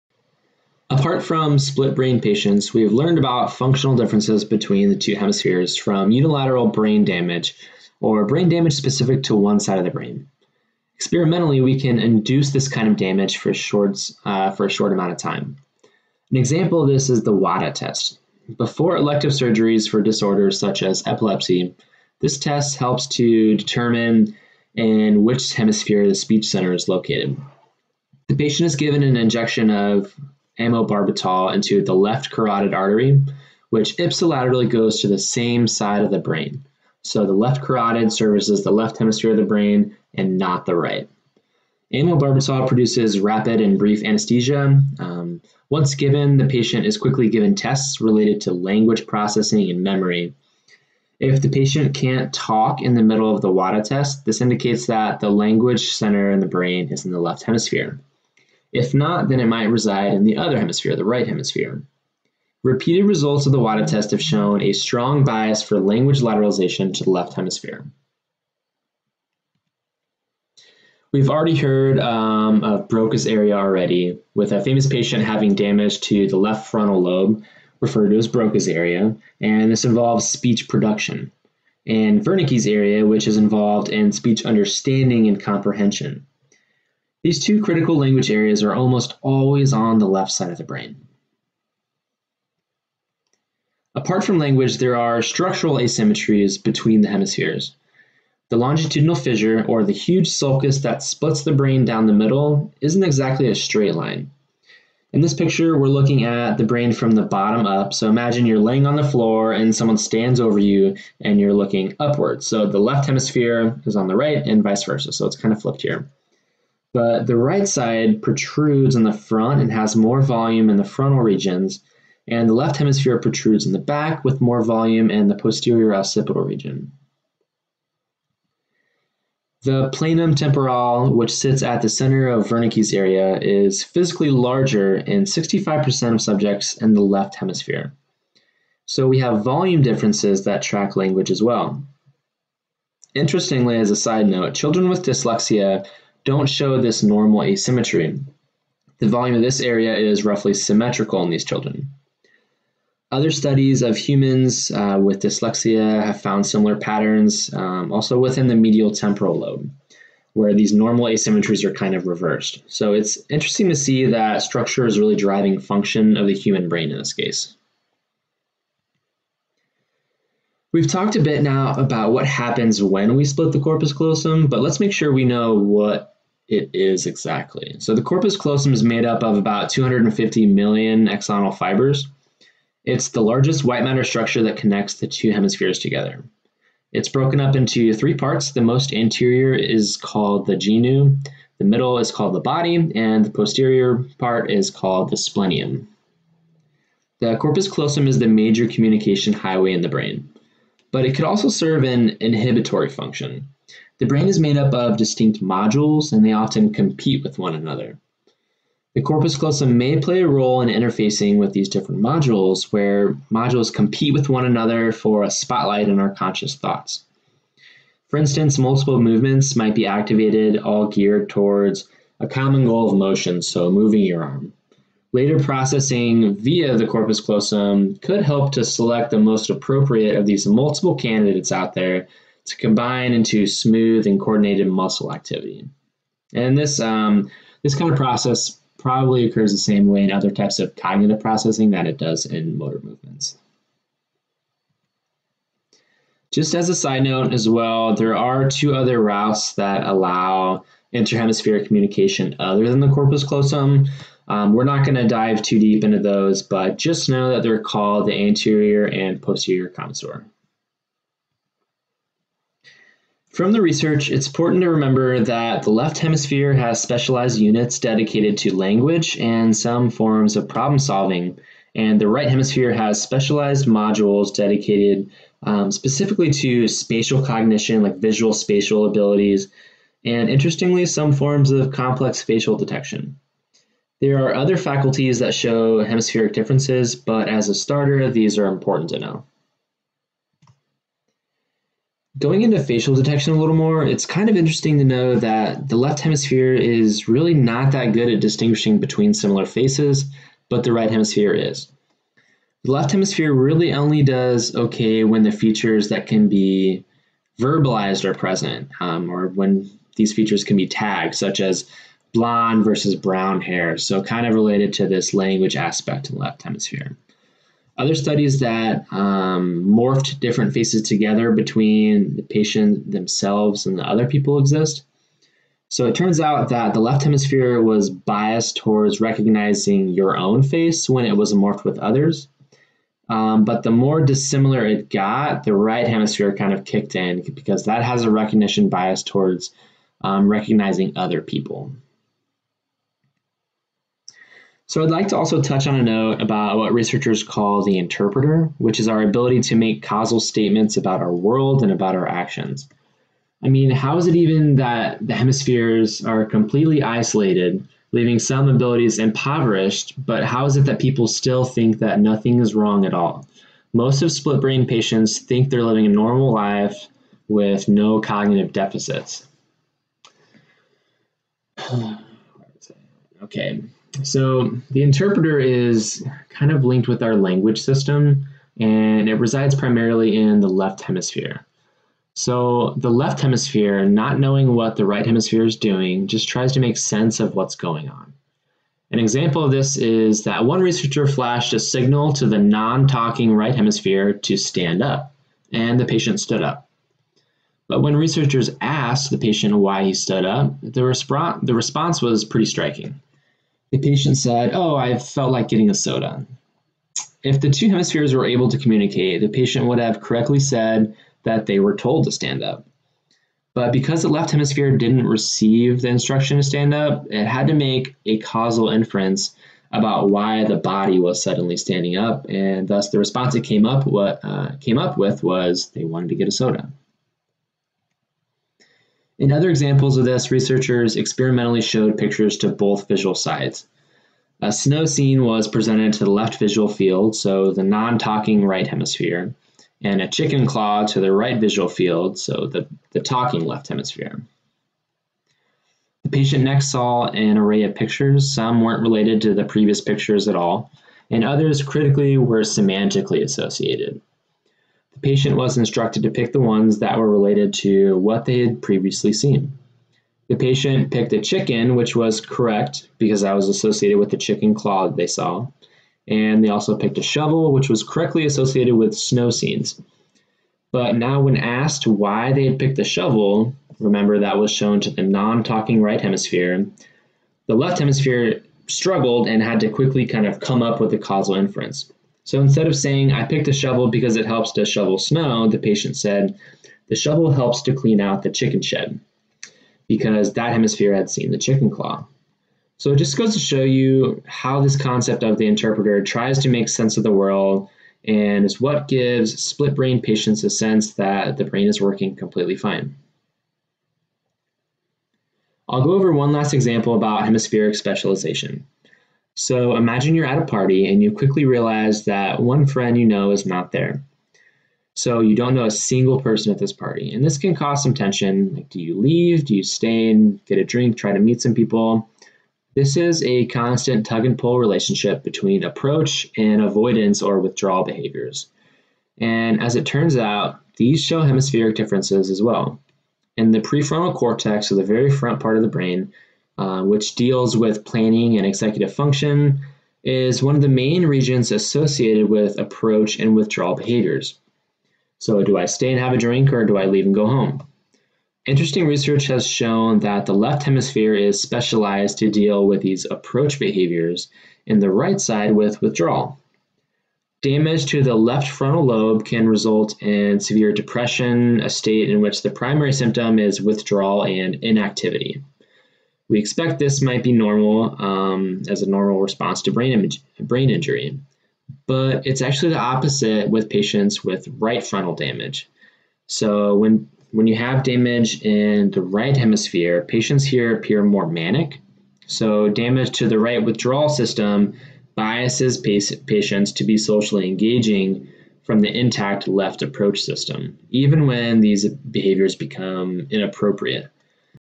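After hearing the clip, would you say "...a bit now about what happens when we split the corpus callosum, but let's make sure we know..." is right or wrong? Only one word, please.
right.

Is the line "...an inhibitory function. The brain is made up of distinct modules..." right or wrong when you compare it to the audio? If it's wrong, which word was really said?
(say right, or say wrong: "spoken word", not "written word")
right.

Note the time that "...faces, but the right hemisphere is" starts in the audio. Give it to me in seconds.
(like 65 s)
299 s.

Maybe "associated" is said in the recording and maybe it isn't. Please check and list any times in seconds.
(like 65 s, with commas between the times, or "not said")
453 s, 463 s, 468 s, 541 s.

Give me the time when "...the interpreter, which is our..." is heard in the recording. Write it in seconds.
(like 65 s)
347 s.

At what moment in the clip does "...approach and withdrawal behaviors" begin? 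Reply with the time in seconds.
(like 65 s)
542 s.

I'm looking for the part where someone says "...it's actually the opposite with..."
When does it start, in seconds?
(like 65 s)
572 s.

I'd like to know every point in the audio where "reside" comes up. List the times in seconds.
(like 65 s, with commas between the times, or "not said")
59 s, 379 s.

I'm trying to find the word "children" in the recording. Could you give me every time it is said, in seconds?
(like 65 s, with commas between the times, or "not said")
144 s, 151 s.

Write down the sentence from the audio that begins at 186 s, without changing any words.
It's broken up into three parts.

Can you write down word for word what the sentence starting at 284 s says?
There are other faculties that show hemispheric differences, but as a starter, these are important to know.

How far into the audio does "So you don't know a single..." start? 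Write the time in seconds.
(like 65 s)
514 s.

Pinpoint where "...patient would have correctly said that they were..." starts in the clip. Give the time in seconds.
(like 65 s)
409 s.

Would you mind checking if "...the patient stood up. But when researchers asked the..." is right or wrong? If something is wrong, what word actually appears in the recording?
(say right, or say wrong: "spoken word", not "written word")
right.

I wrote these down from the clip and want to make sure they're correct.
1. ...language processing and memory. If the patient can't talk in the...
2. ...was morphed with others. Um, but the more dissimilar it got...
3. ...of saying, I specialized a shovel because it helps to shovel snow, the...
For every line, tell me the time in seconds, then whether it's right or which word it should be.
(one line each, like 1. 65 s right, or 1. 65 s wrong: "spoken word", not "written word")
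1. 48 s right
2. 331 s right
3. 482 s wrong: "picked", not "specialized".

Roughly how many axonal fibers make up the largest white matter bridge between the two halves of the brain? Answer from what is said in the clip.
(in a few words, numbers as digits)
250 million.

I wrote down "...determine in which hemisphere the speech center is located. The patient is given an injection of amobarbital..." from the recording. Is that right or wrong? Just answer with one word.
right.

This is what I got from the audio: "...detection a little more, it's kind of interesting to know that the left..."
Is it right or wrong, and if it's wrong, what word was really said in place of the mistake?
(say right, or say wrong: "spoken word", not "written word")
right.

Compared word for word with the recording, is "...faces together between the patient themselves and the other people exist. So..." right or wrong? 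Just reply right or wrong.
right.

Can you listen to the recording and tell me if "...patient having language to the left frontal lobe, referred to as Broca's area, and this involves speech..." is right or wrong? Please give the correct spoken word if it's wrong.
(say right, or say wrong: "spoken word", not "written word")
wrong: "damage", not "language".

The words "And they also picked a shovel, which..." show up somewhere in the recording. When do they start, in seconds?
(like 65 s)
466 s.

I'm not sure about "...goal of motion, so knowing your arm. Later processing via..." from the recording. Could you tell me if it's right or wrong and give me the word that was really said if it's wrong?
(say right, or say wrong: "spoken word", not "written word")
wrong: "moving", not "knowing".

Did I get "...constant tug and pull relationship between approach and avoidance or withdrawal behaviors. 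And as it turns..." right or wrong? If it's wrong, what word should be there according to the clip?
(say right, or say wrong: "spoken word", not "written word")
right.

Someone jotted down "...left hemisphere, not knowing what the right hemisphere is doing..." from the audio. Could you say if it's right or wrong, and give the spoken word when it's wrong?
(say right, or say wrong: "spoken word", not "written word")
right.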